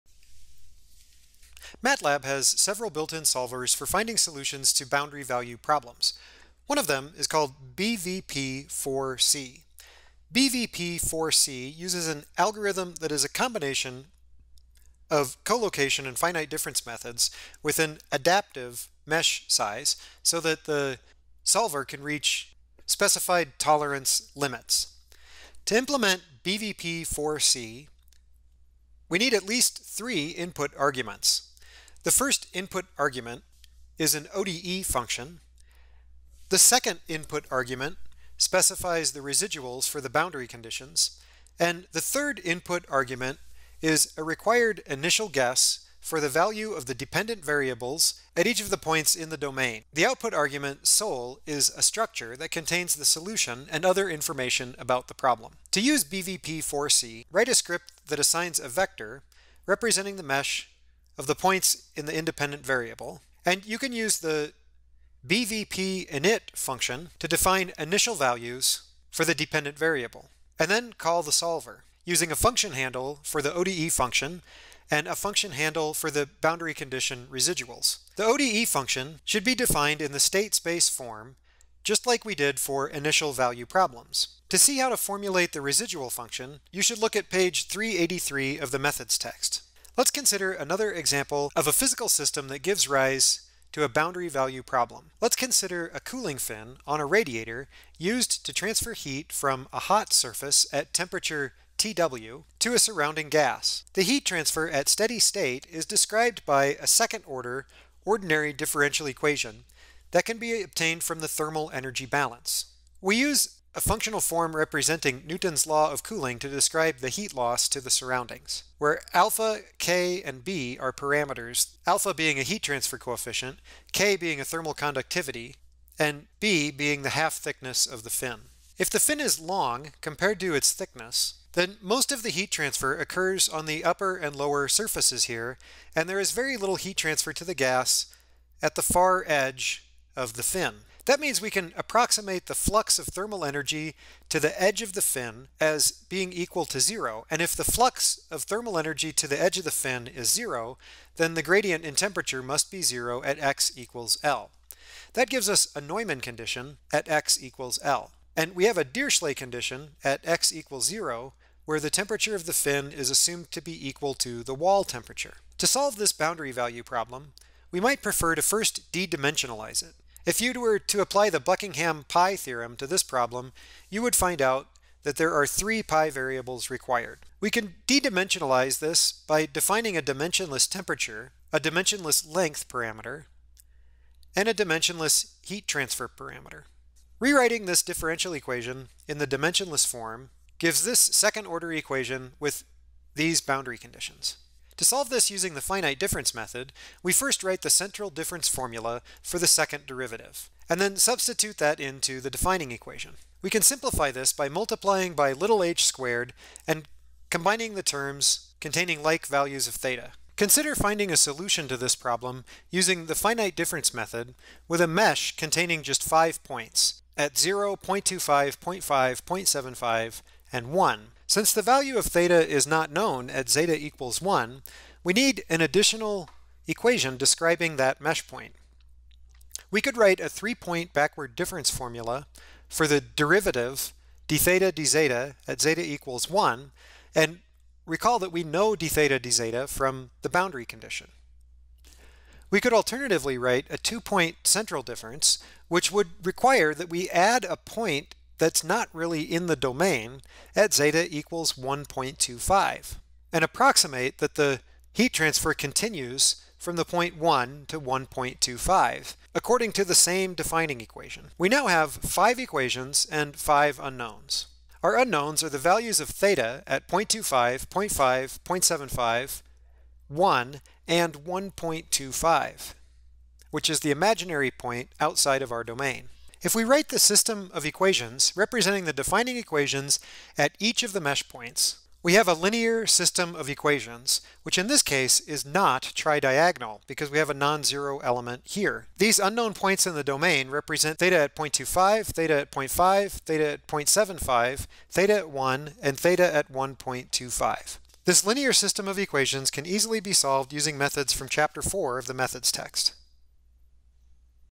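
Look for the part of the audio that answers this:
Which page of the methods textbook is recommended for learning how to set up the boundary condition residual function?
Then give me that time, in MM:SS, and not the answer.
01:27.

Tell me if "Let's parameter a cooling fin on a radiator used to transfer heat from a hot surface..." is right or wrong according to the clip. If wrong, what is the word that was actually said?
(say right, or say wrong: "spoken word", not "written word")
wrong: "consider", not "parameter".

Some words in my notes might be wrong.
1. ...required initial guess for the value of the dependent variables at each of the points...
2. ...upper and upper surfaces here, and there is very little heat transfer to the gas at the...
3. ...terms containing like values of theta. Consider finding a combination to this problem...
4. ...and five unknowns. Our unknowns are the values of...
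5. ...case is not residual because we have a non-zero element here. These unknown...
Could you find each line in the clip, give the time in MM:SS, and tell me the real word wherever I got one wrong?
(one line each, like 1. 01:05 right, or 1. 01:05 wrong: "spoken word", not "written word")
1. 00:44 right
2. 02:13 wrong: "lower", not "upper"
3. 03:27 wrong: "solution", not "combination"
4. 04:23 right
5. 04:44 wrong: "tridiagonal", not "residual".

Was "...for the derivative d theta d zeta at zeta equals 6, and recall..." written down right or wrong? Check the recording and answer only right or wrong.
wrong.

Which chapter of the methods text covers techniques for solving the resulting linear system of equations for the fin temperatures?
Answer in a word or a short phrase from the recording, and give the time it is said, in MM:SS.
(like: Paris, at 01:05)
Chapter 4, at 05:01.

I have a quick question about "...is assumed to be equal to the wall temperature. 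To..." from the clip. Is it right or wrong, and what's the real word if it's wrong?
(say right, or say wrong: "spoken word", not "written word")
right.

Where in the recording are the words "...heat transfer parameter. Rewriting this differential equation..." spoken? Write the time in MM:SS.
03:05.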